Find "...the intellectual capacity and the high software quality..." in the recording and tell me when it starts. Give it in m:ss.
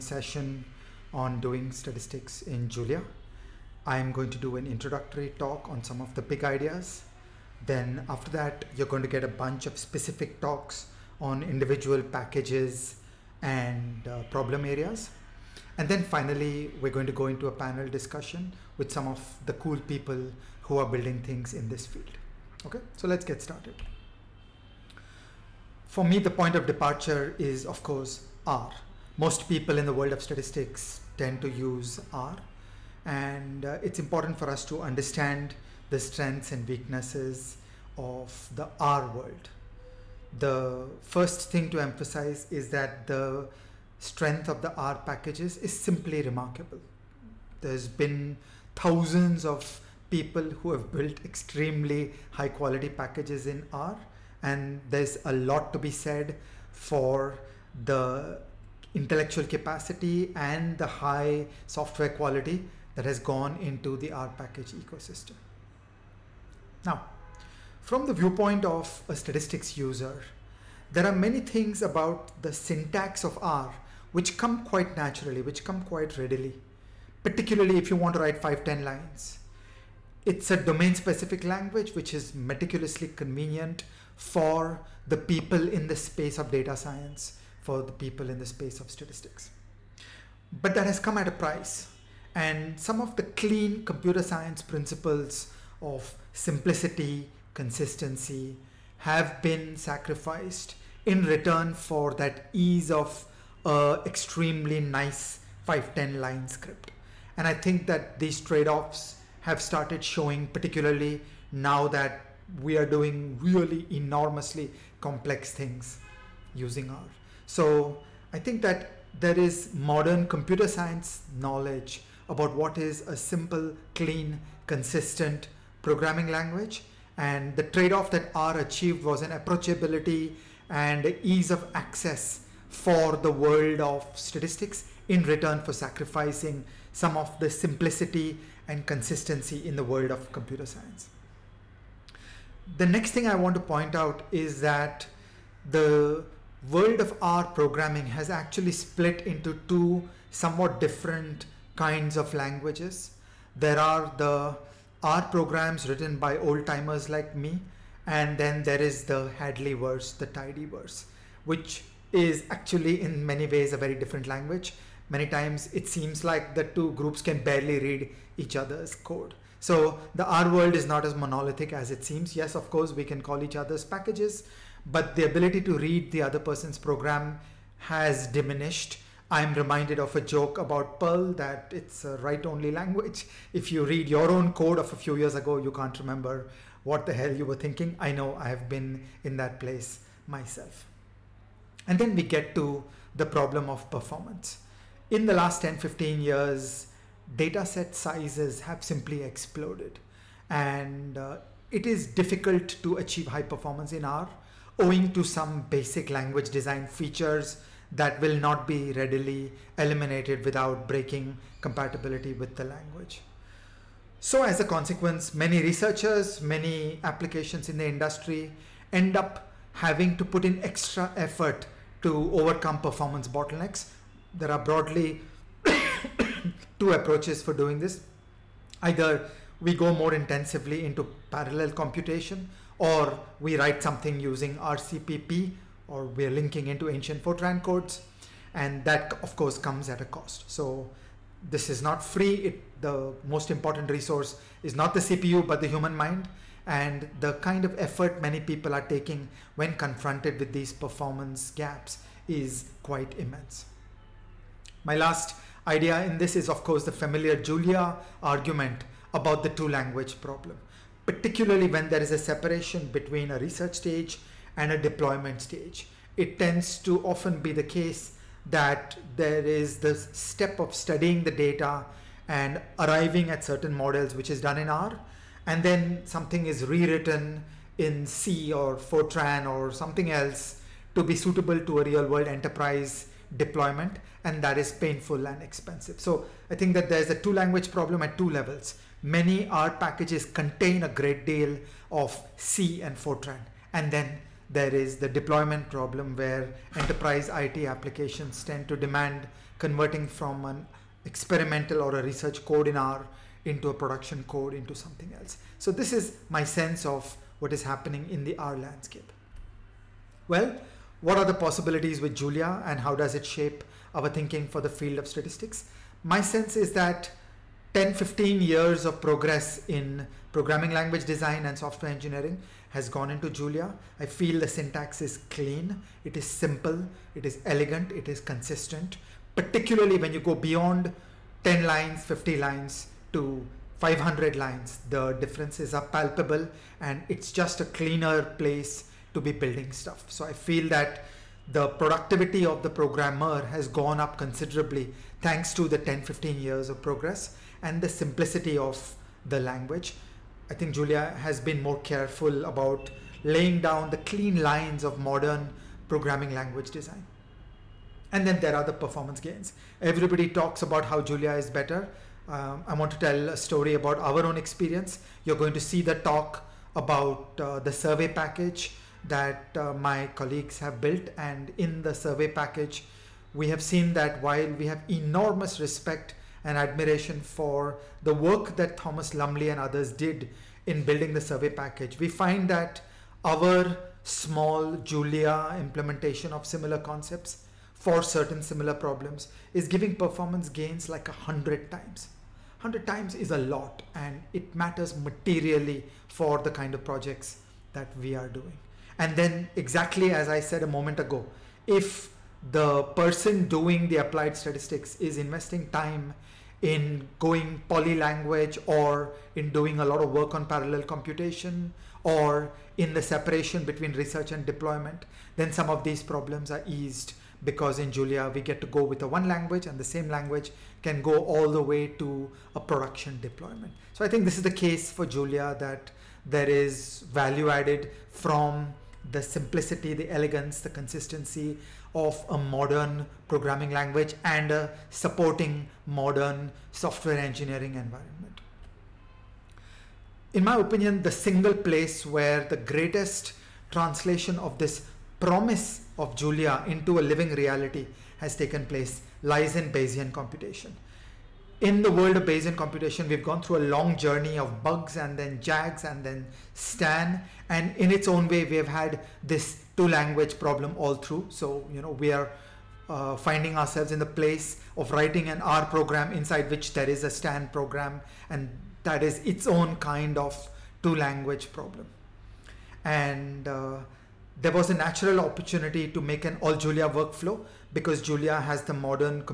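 0:57.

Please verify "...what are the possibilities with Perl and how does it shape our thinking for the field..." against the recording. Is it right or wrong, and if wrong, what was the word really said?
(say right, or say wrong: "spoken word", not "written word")
wrong: "Julia", not "Perl".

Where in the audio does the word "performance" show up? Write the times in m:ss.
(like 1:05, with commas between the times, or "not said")
3:13, 3:23, 3:42, 4:10, 5:58, 6:29.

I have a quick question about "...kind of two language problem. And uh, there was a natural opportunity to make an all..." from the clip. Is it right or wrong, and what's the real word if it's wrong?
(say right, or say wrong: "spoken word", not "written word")
right.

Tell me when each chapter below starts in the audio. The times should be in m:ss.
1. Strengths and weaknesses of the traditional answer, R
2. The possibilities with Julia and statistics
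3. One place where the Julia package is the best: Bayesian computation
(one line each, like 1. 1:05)
1. 0:23
2. 5:09
3. 7:18.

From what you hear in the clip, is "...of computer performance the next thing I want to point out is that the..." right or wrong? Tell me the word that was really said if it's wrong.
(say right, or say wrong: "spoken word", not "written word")
wrong: "science", not "performance".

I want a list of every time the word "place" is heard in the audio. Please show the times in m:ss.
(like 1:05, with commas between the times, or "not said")
3:09, 5:38, 7:21, 7:28, 7:44.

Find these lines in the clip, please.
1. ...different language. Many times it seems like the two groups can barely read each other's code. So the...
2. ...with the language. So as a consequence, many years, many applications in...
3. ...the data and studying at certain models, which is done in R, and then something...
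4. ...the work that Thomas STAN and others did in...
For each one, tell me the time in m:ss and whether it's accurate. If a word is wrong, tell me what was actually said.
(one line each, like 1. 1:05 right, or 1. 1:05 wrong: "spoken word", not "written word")
1. 2:43 right
2. 3:32 wrong: "researchers", not "years"
3. 4:31 wrong: "arriving", not "studying"
4. 6:18 wrong: "Lumley", not "STAN".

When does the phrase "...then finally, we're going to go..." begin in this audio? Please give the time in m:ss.
0:15.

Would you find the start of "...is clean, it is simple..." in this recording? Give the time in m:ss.
5:25.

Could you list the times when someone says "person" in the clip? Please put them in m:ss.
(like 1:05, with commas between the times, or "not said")
2:56, 6:42.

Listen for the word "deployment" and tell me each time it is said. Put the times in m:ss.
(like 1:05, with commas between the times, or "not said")
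4:24, 4:43, 4:55, 6:54, 7:03.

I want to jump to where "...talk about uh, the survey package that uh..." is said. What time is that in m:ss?
6:05.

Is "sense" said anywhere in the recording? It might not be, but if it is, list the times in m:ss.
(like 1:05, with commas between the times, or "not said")
5:06, 5:16.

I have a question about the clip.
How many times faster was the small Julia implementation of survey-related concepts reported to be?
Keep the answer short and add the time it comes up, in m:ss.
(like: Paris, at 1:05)
100 times, at 6:31.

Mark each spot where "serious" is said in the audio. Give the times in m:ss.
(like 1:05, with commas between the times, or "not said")
not said.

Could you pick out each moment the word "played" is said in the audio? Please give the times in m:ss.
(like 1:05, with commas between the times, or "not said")
not said.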